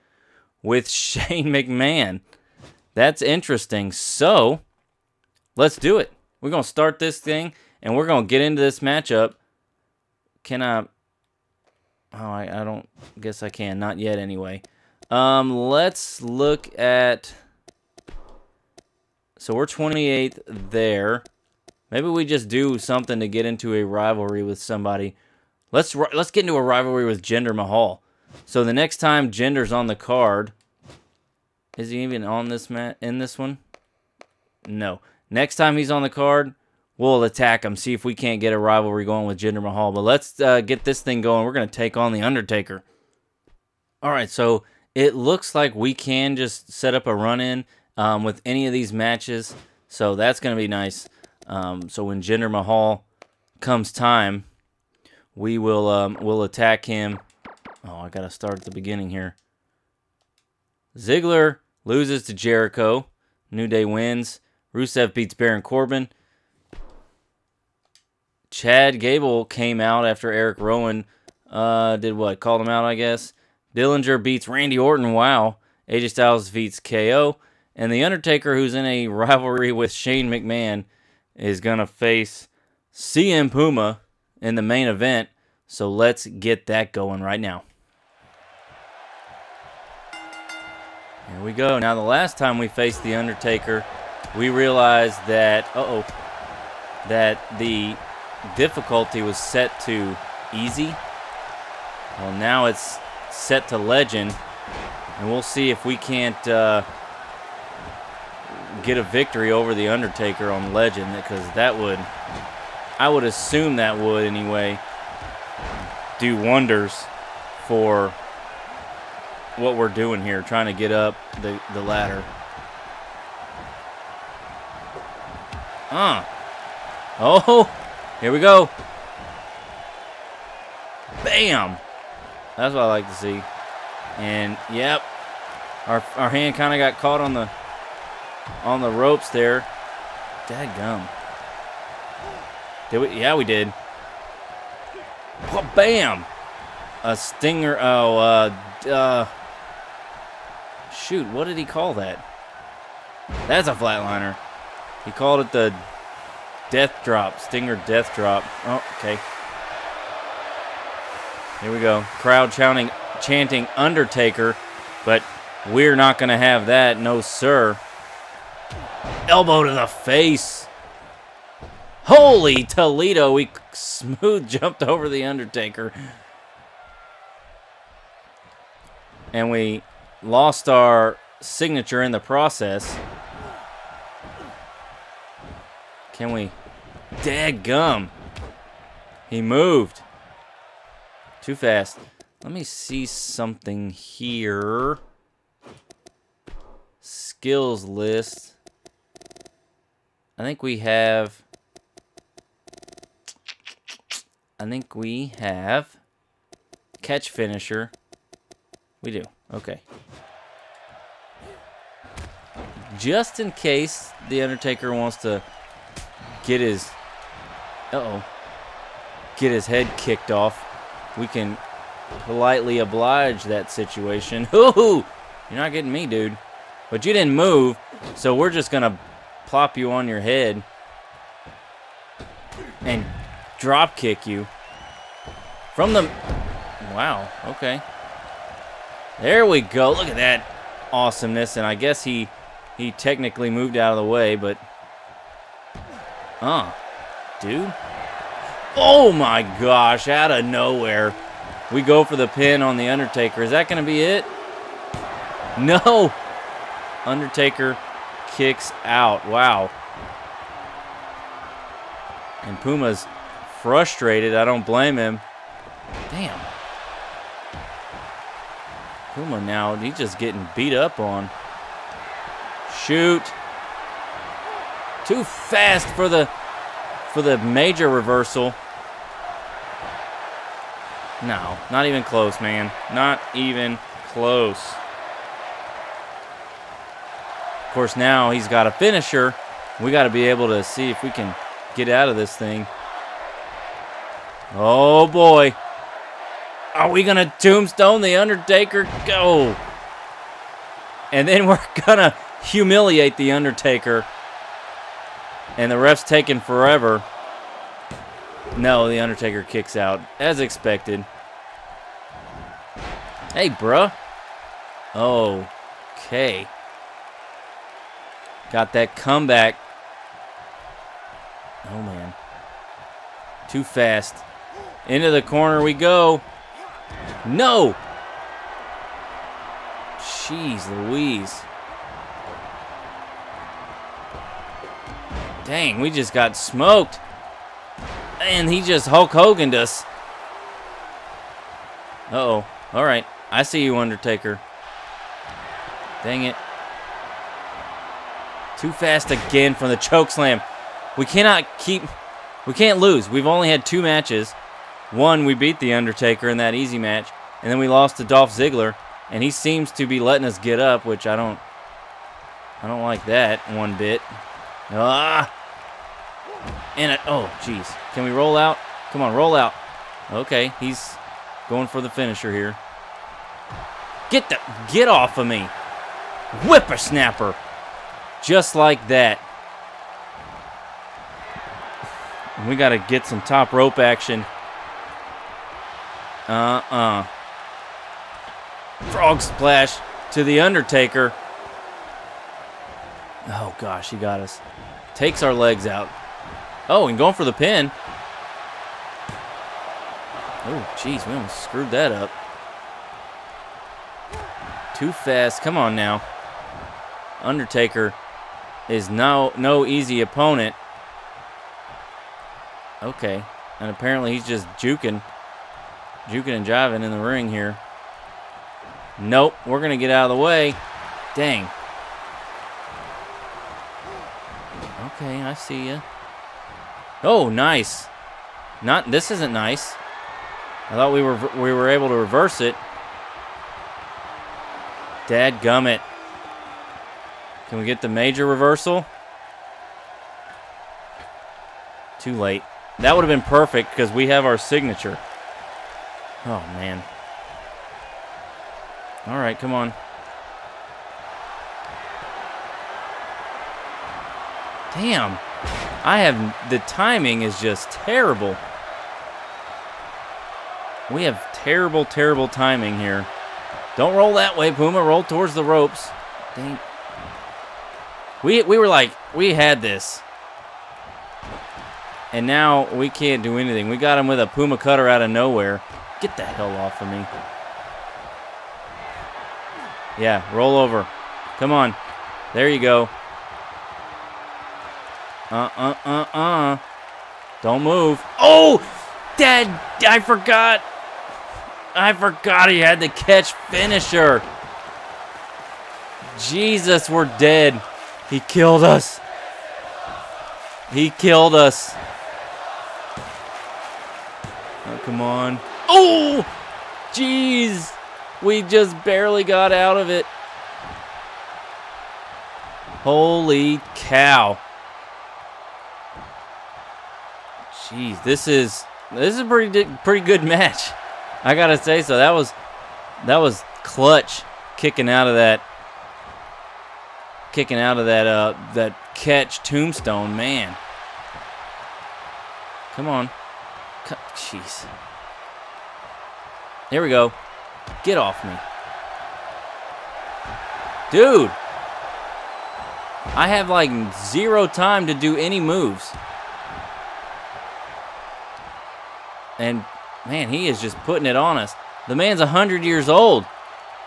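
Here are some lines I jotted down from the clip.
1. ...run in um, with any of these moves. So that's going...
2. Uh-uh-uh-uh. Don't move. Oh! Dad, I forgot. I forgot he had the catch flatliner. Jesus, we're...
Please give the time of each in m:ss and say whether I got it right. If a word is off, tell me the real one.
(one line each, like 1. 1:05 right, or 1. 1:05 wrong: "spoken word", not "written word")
1. 0:47 wrong: "matches", not "moves"
2. 8:05 wrong: "finisher", not "flatliner".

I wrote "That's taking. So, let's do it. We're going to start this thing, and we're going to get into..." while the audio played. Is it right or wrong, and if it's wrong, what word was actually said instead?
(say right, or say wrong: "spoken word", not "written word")
wrong: "interesting", not "taking".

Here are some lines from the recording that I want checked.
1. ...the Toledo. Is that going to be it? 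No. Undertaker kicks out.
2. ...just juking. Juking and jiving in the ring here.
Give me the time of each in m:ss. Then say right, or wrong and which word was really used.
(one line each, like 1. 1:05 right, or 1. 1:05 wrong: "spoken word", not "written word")
1. 4:12 wrong: "Undertaker", not "Toledo"
2. 6:54 right.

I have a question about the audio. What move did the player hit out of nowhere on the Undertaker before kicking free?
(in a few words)
Puma cutter.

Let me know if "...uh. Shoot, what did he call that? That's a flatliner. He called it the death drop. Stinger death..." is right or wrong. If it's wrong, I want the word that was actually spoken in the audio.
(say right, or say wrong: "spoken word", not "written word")
right.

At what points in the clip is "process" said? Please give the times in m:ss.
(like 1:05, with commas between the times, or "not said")
3:02.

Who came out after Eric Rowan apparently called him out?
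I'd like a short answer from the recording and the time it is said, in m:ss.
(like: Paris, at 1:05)
Chad Gable, at 1:08.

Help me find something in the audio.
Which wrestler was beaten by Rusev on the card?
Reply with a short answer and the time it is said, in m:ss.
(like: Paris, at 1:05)
Baron Corbin, at 1:05.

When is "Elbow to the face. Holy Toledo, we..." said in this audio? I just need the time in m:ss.
2:49.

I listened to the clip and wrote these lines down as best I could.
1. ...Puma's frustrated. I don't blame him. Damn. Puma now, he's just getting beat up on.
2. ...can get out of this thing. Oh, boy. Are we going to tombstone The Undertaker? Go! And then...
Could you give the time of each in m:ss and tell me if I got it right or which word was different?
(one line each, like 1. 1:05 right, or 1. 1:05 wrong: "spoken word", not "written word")
1. 4:22 right
2. 4:51 right.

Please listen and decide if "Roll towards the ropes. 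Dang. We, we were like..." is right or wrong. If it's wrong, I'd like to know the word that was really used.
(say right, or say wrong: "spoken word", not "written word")
right.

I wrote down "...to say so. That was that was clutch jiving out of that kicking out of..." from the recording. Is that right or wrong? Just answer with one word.
wrong.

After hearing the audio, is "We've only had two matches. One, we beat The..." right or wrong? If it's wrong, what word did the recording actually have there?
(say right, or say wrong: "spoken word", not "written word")
right.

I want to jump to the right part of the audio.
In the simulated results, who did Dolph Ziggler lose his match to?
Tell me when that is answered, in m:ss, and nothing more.
1:02.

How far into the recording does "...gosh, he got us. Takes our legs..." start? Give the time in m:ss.
6:33.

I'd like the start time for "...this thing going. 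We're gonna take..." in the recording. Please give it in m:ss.
0:40.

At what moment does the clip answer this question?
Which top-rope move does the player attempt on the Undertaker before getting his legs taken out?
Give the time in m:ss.
6:28.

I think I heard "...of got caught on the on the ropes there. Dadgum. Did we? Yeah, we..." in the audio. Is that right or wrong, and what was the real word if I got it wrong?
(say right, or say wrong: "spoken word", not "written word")
right.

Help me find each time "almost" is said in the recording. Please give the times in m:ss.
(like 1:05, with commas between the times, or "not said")
6:41.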